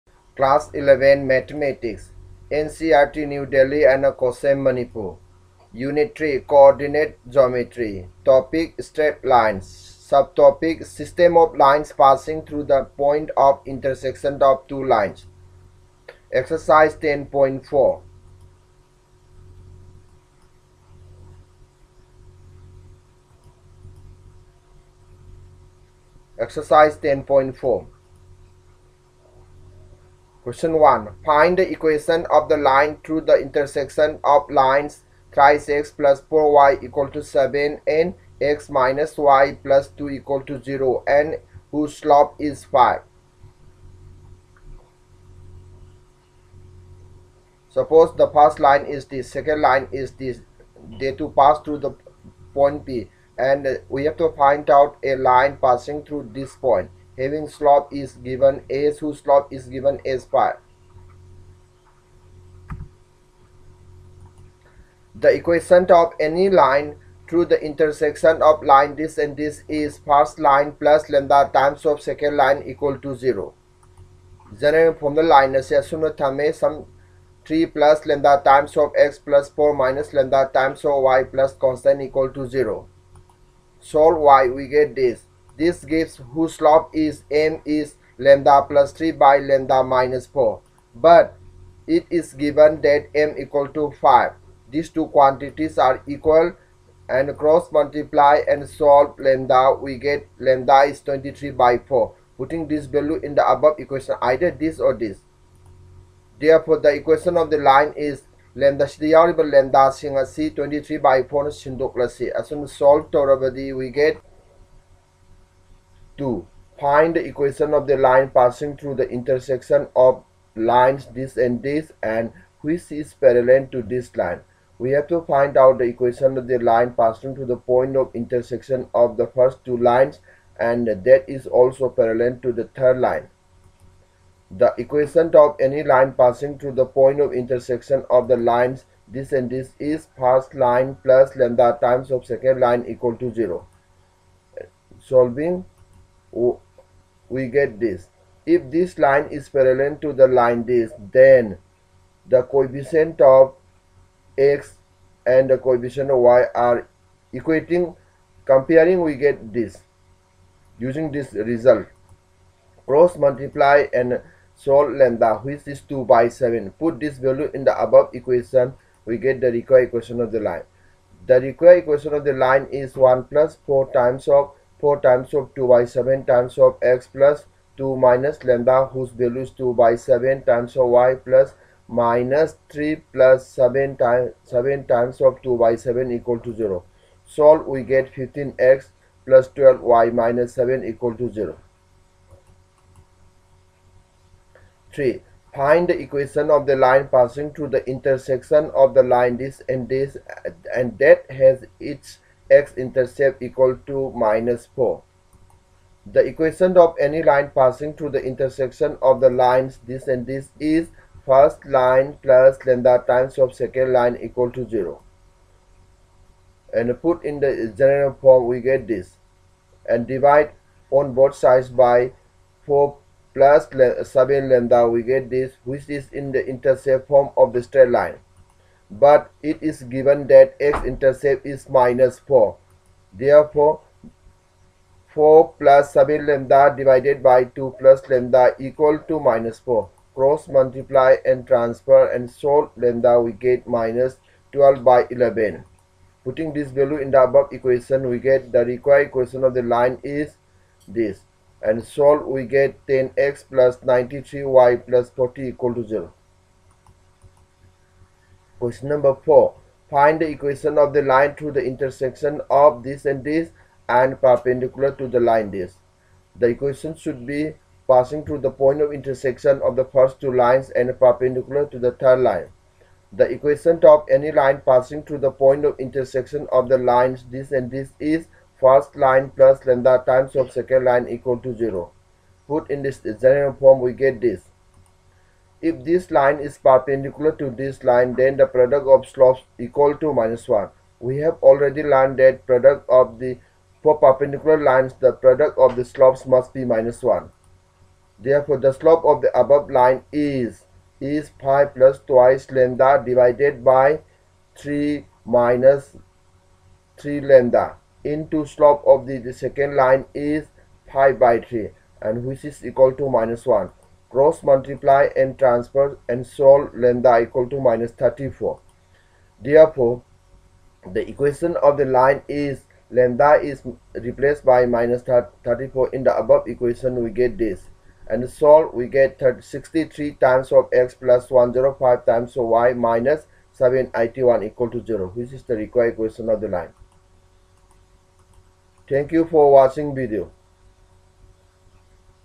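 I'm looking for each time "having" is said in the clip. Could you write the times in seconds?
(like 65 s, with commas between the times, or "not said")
57 s.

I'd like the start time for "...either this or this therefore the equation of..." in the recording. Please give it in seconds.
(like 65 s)
104 s.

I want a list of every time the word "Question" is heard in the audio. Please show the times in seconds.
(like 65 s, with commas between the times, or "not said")
30 s, 258 s.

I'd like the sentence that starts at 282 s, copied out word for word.
Put in this general form we get this.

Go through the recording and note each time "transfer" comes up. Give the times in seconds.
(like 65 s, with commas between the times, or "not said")
241 s, 315 s.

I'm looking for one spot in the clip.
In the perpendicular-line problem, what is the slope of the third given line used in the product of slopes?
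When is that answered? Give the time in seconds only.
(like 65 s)
310 s.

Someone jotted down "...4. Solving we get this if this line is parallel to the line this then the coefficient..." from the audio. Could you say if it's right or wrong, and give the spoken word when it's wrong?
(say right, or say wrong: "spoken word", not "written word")
wrong: "0", not "4".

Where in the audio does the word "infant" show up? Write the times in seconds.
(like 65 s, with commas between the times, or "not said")
not said.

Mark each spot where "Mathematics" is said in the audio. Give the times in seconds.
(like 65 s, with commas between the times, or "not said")
1 s.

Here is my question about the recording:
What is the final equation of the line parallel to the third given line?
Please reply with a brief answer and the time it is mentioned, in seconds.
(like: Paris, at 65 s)
15x + 12y - 7 = 0, at 188 s.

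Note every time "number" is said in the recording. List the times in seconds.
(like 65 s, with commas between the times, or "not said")
258 s.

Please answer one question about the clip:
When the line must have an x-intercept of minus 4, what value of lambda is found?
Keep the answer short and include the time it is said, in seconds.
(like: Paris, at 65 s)
-12/11, at 243 s.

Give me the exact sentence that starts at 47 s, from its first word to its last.
Suppose the first line is this, second line is this.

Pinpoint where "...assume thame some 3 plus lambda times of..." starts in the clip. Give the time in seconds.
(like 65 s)
75 s.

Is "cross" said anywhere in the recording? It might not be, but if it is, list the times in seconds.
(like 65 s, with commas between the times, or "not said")
97 s, 162 s, 240 s, 314 s.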